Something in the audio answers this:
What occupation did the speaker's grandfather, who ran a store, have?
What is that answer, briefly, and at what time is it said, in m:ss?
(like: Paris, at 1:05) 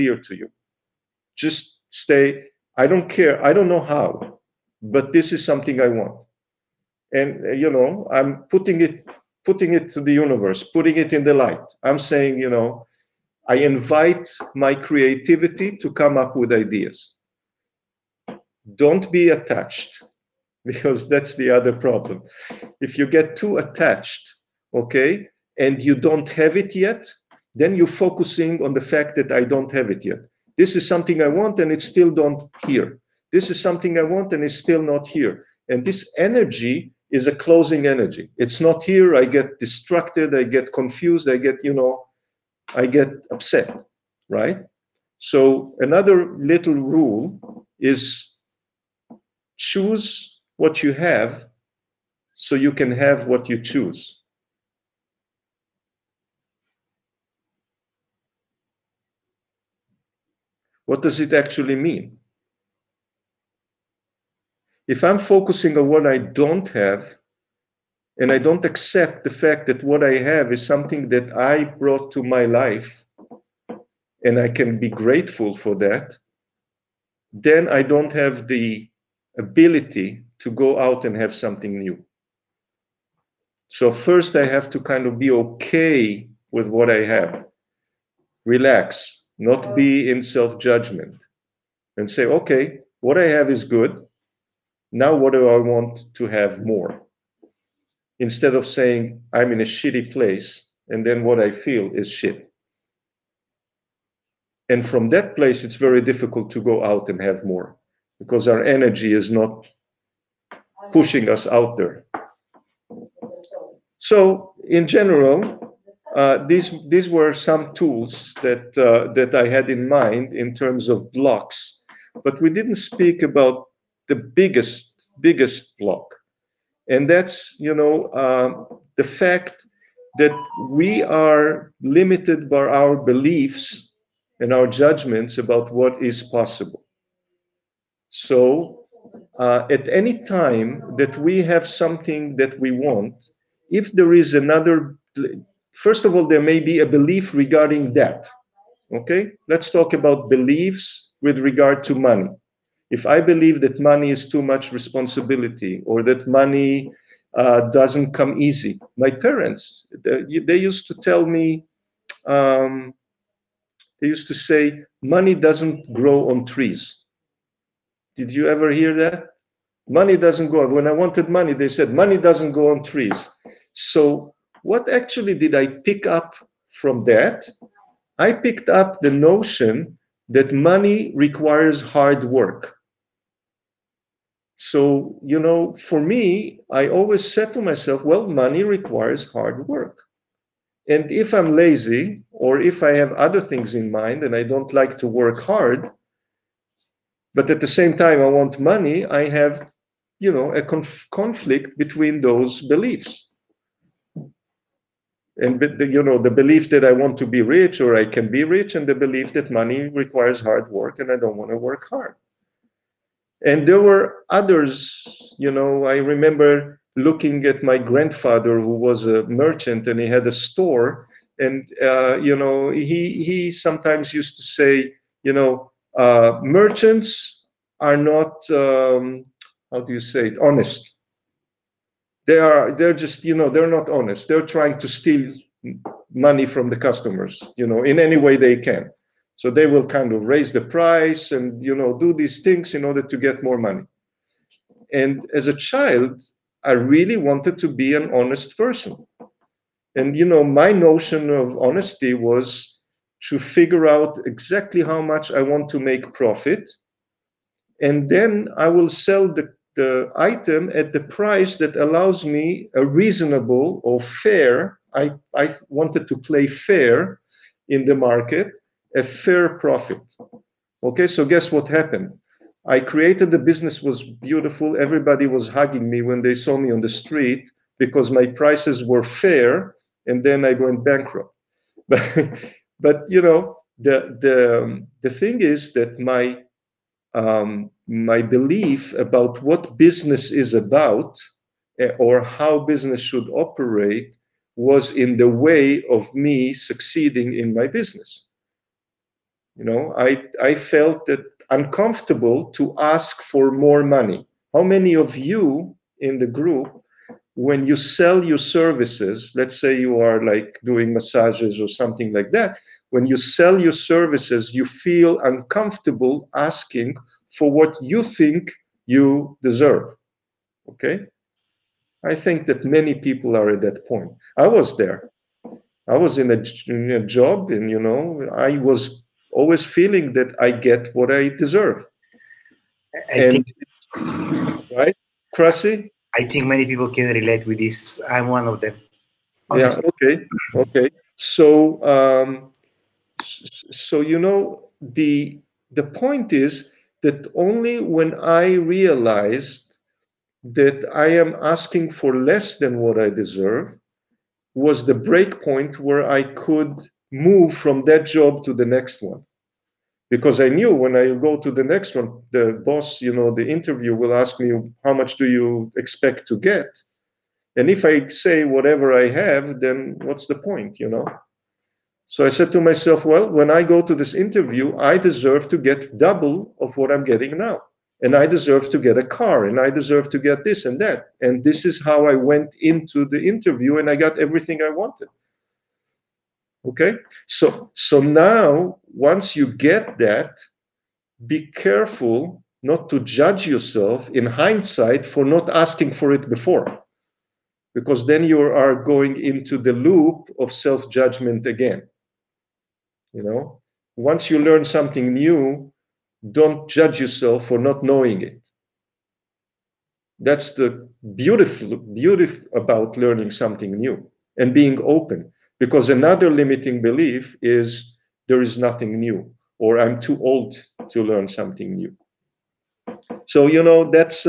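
Merchant, at 3:39.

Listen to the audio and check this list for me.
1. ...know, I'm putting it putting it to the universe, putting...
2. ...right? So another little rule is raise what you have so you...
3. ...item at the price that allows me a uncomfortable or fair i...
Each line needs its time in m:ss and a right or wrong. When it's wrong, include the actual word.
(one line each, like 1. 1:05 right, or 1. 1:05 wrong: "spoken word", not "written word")
1. 0:07 right
2. 0:44 wrong: "choose", not "raise"
3. 4:20 wrong: "reasonable", not "uncomfortable".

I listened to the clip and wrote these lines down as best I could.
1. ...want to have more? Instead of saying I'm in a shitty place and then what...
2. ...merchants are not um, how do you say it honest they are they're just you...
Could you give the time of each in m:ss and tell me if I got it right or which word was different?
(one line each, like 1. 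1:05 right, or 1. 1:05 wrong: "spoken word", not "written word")
1. 1:35 right
2. 3:46 right.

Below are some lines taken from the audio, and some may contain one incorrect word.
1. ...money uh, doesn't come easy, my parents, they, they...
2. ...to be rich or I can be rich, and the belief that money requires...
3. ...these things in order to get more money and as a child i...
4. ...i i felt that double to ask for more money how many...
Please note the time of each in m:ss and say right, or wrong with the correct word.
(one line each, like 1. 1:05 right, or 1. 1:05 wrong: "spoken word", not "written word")
1. 2:36 right
2. 3:27 right
3. 4:02 right
4. 4:59 wrong: "uncomfortable", not "double".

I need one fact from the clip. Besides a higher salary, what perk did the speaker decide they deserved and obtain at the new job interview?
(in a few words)
A car.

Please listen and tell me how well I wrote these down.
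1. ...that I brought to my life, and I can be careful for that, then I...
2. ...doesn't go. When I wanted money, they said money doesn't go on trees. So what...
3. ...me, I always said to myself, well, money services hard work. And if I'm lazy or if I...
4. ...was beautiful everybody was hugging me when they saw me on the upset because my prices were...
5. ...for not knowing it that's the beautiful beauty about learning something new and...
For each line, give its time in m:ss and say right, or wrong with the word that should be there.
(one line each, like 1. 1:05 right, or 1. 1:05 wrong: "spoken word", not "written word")
1. 1:11 wrong: "grateful", not "careful"
2. 2:50 right
3. 3:05 wrong: "requires", not "services"
4. 4:33 wrong: "street", not "upset"
5. 6:47 right.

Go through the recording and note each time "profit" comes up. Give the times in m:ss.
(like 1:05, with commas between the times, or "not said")
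4:16, 4:29.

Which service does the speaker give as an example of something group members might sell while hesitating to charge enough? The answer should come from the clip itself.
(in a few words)
Massages.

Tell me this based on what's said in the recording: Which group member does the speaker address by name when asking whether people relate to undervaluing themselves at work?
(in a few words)
Krasi.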